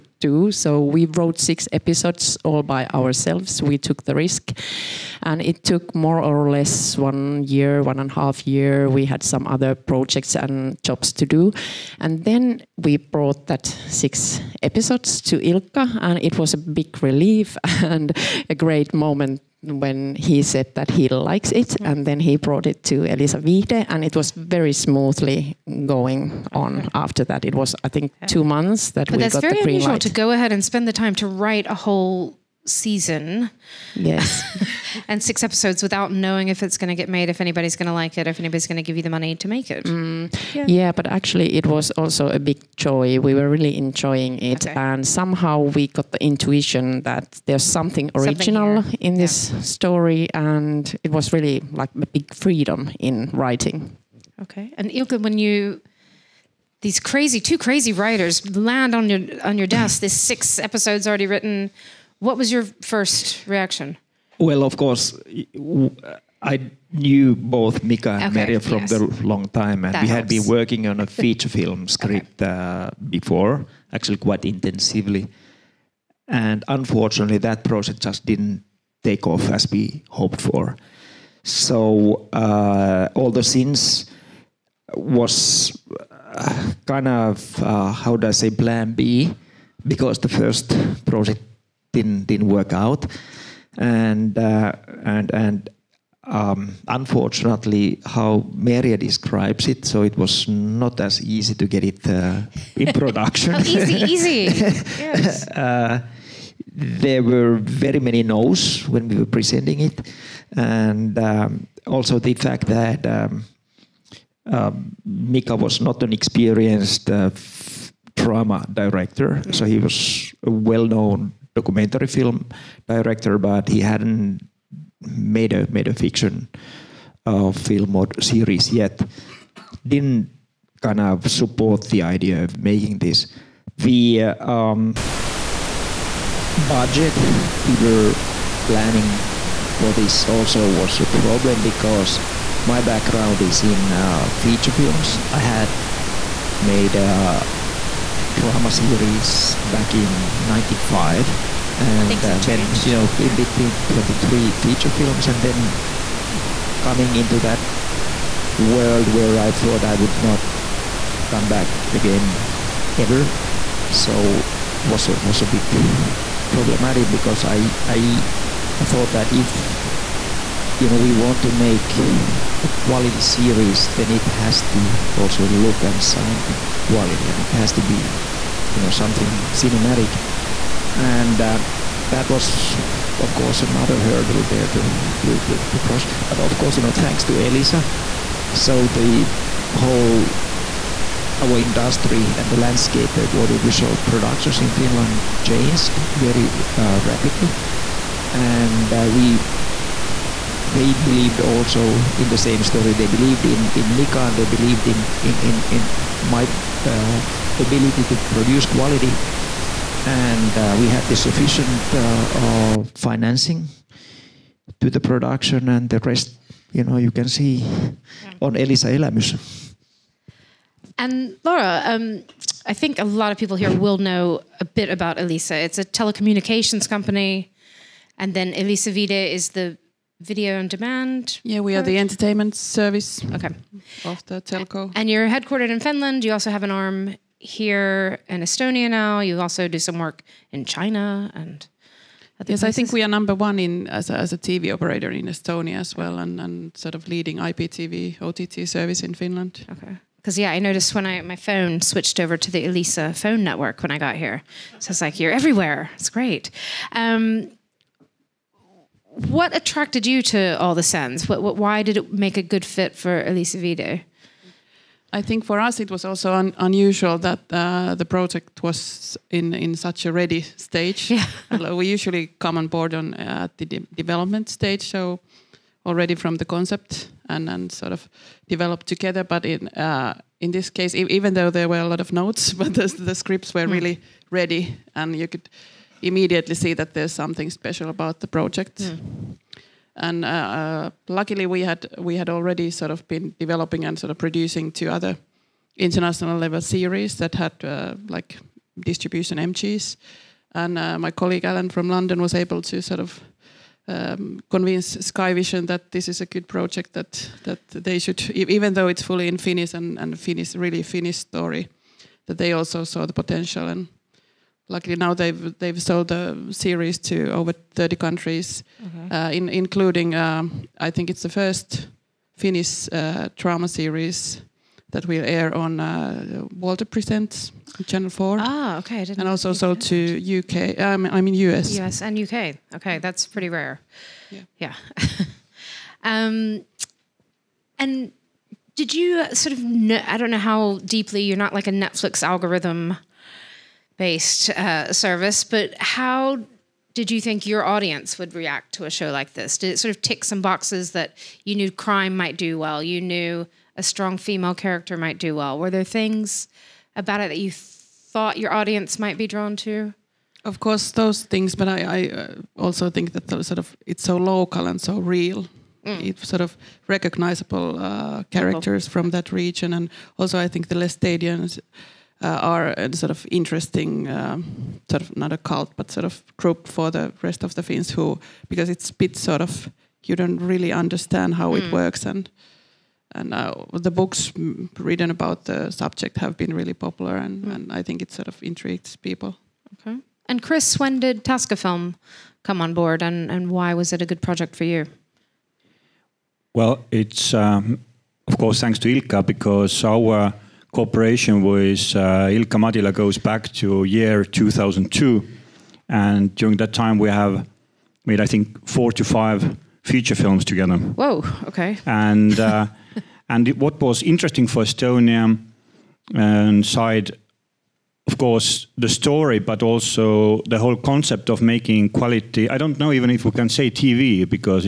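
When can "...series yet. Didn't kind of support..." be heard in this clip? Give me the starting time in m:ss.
2:08.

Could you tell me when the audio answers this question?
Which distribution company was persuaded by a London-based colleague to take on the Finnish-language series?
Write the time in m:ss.
5:05.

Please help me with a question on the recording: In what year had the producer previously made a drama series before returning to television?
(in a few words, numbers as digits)
1995.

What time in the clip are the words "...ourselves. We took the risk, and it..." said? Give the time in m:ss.
0:02.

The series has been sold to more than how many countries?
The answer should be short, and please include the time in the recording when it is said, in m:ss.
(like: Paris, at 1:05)
30, at 5:17.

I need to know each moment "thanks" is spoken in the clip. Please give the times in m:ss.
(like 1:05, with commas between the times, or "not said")
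3:06, 6:38.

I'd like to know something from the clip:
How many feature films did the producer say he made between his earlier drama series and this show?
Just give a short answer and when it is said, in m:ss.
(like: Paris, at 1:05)
23, at 2:33.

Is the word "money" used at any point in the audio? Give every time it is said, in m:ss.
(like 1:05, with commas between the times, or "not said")
0:39.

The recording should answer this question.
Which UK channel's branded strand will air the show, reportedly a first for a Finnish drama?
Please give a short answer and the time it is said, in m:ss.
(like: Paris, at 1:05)
Walter Presents Channel Four, at 5:26.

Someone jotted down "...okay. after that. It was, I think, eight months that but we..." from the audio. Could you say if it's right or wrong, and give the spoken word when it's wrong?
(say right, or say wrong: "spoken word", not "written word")
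wrong: "two", not "eight".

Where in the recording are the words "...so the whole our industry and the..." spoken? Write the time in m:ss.
3:08.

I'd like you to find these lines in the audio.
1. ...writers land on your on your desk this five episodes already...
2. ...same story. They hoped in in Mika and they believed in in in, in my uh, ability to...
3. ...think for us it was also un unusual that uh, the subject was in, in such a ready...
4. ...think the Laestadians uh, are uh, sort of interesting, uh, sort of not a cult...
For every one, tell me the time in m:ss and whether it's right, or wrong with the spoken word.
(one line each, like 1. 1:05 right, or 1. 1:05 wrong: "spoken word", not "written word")
1. 0:57 wrong: "six", not "five"
2. 3:22 wrong: "believed", not "hoped"
3. 4:25 wrong: "project", not "subject"
4. 6:10 right.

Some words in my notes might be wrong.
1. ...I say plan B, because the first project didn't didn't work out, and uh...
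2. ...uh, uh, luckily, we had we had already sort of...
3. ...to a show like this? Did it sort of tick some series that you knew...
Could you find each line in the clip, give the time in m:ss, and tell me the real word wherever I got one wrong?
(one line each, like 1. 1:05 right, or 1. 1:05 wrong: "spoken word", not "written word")
1. 1:28 right
2. 4:50 right
3. 5:48 wrong: "boxes", not "series".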